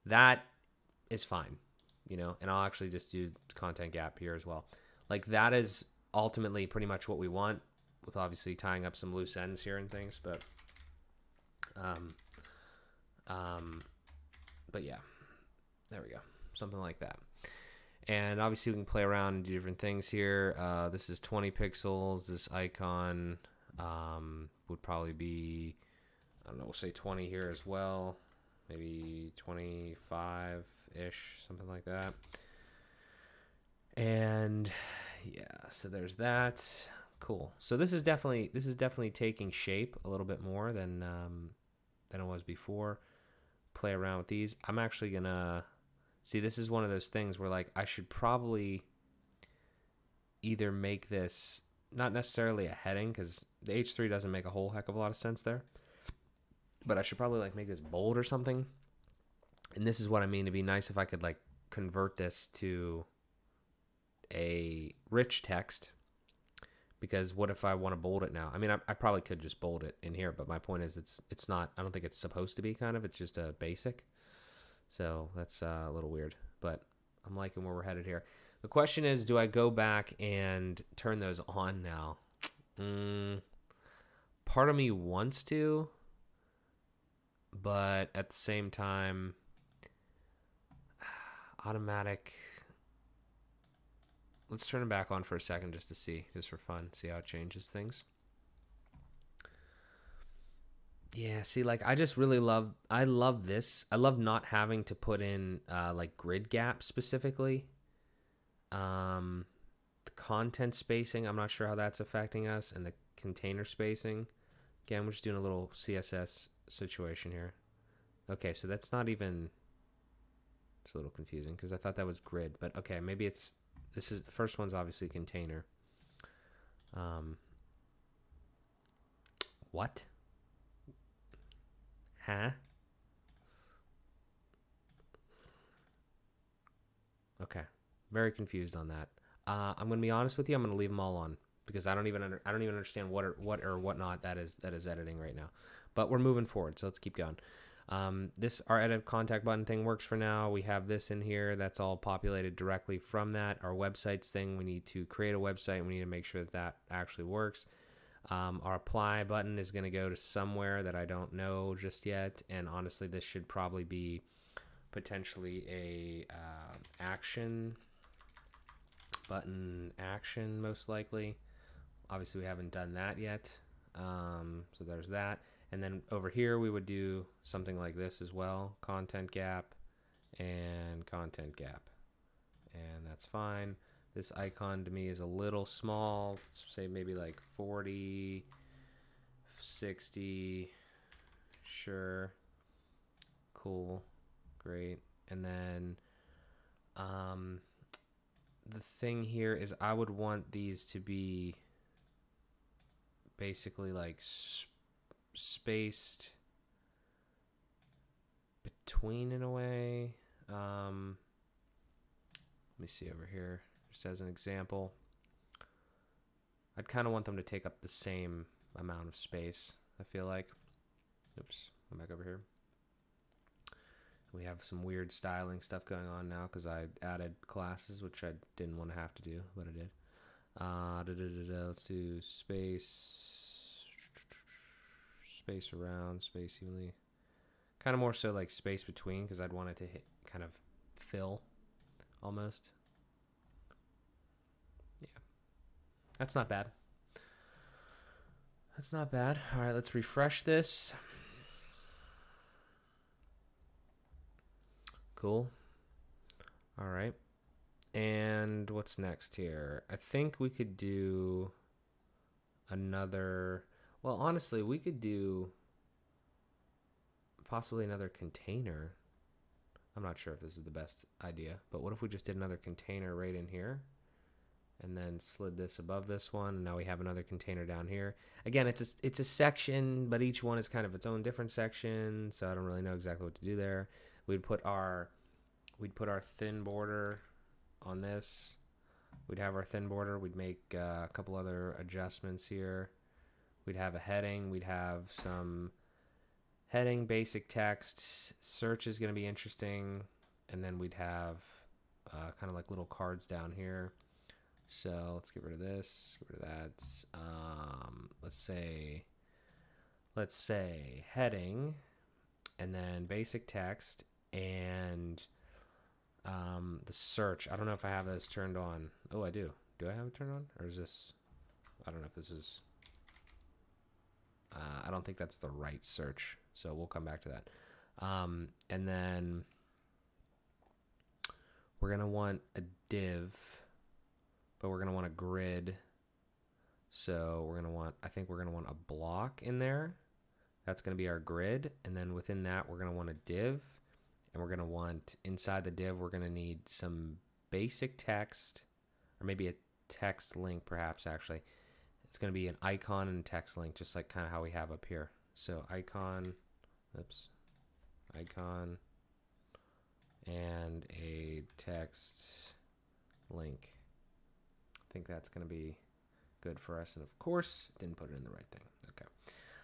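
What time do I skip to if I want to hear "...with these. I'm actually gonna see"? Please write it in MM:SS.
00:44.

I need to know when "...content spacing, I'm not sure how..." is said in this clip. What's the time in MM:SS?
01:50.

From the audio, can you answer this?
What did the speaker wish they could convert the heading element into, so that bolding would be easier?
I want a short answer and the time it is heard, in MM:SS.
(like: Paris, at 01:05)
rich text, at 01:05.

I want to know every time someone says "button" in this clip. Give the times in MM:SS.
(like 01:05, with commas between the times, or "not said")
02:29, 02:39, 02:49.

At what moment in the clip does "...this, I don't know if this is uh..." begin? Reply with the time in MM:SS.
05:20.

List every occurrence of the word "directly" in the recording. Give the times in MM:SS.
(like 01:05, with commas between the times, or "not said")
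02:32.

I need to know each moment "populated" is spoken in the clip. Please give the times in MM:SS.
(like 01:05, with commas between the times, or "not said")
02:31.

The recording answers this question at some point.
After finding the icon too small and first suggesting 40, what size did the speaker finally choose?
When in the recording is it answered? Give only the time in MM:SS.
03:09.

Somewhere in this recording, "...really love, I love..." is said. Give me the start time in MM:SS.
01:42.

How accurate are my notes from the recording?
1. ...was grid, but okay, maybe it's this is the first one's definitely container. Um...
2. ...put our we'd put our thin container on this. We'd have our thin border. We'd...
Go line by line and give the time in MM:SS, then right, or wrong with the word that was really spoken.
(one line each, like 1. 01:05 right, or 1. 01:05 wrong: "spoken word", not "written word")
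1. 02:02 wrong: "obviously", not "definitely"
2. 04:44 wrong: "border", not "container".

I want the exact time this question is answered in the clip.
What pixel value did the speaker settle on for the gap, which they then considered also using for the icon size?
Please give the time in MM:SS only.
00:21.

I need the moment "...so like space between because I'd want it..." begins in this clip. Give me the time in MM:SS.
03:58.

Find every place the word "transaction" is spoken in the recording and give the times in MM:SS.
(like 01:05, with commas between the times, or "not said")
not said.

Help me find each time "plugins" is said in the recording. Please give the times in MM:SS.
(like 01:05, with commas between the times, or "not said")
not said.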